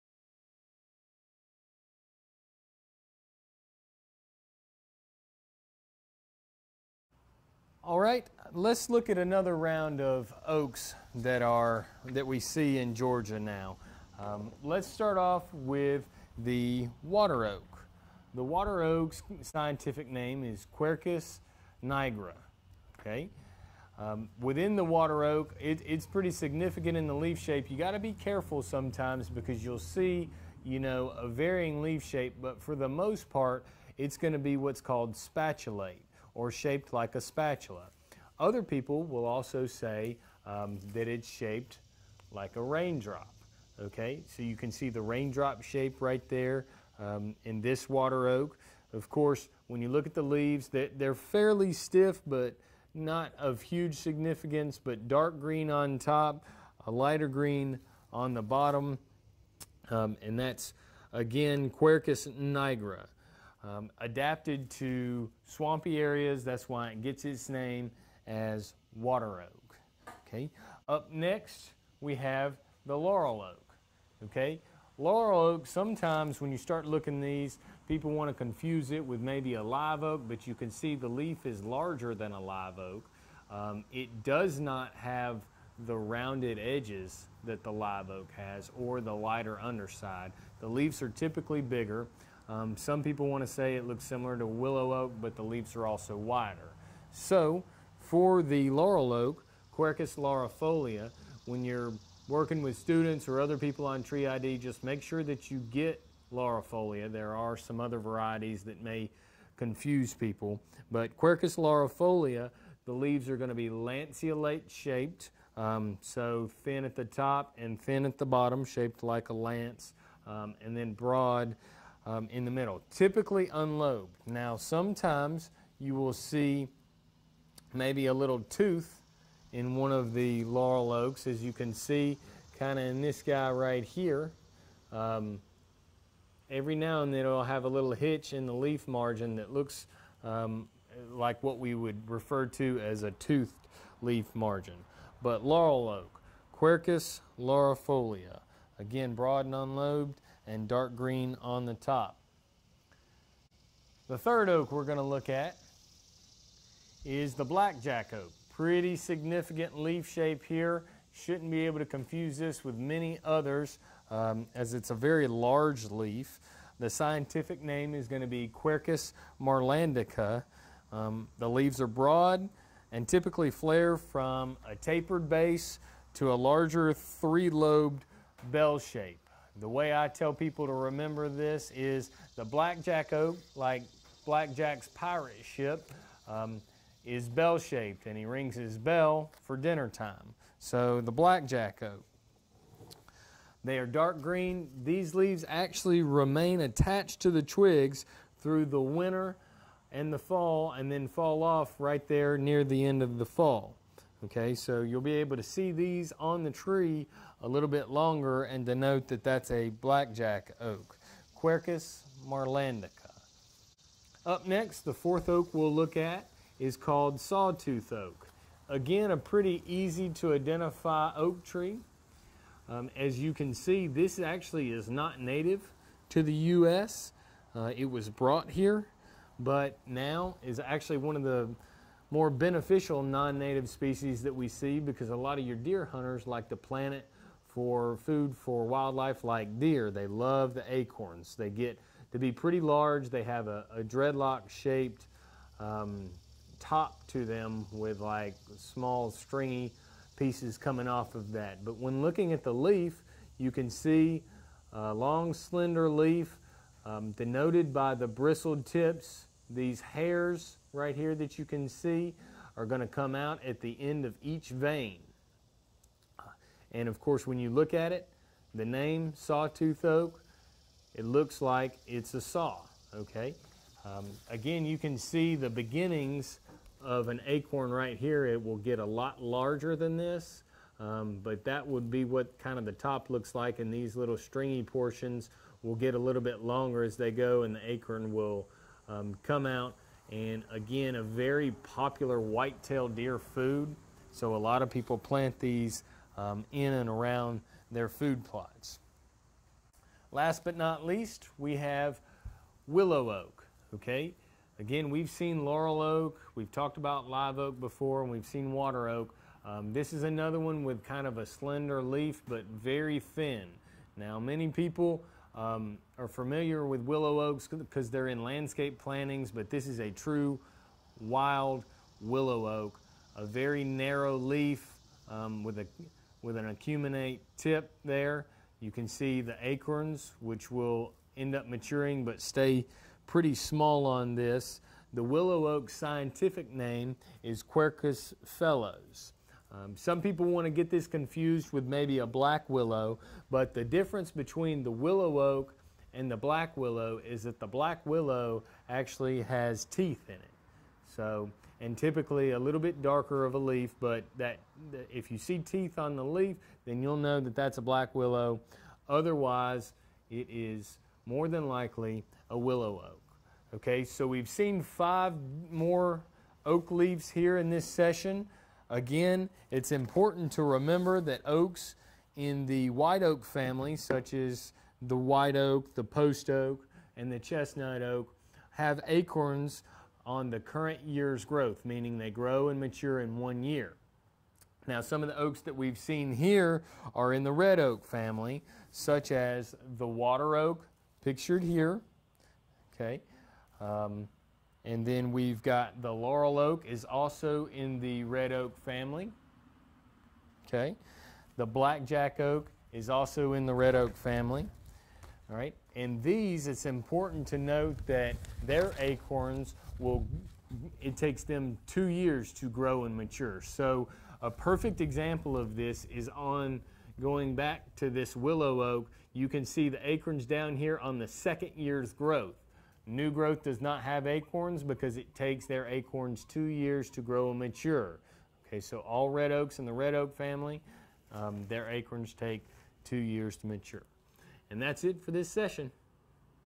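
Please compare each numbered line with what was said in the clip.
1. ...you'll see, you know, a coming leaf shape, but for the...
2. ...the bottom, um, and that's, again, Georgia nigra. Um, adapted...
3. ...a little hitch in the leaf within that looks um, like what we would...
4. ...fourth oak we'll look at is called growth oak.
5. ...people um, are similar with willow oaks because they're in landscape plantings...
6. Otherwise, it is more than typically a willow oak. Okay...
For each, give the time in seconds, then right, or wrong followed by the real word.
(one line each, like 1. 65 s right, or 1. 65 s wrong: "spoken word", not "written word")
1. 29 s wrong: "varying", not "coming"
2. 58 s wrong: "Quercus", not "Georgia"
3. 137 s wrong: "margin", not "within"
4. 214 s wrong: "sawtooth", not "growth"
5. 314 s wrong: "familiar", not "similar"
6. 358 s wrong: "likely", not "typically".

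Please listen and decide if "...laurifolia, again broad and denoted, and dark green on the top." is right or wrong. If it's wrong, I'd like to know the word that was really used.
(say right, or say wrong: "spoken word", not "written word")
wrong: "unlobed", not "denoted".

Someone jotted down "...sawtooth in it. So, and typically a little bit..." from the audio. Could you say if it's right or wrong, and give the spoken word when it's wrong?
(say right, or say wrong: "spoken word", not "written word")
wrong: "teeth", not "sawtooth".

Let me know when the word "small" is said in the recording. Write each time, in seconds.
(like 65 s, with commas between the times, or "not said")
248 s, 333 s.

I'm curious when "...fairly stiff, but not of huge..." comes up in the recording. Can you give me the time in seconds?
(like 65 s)
51 s.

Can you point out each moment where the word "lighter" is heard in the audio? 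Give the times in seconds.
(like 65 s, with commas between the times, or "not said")
56 s, 89 s.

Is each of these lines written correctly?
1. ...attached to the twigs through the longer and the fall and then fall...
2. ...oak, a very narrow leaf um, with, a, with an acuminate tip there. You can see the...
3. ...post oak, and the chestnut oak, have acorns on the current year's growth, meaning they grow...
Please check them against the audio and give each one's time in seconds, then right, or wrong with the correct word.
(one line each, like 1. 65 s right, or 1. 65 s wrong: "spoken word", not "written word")
1. 196 s wrong: "winter", not "longer"
2. 322 s right
3. 375 s right.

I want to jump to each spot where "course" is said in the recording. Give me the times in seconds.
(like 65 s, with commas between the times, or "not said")
49 s, 266 s.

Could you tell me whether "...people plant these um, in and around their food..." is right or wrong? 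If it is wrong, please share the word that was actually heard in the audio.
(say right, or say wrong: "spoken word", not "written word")
right.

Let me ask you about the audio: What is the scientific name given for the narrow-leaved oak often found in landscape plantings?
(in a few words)
Quercus phellos.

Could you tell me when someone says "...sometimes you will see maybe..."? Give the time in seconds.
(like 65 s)
124 s.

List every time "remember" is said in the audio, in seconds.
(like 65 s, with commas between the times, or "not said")
180 s, 370 s.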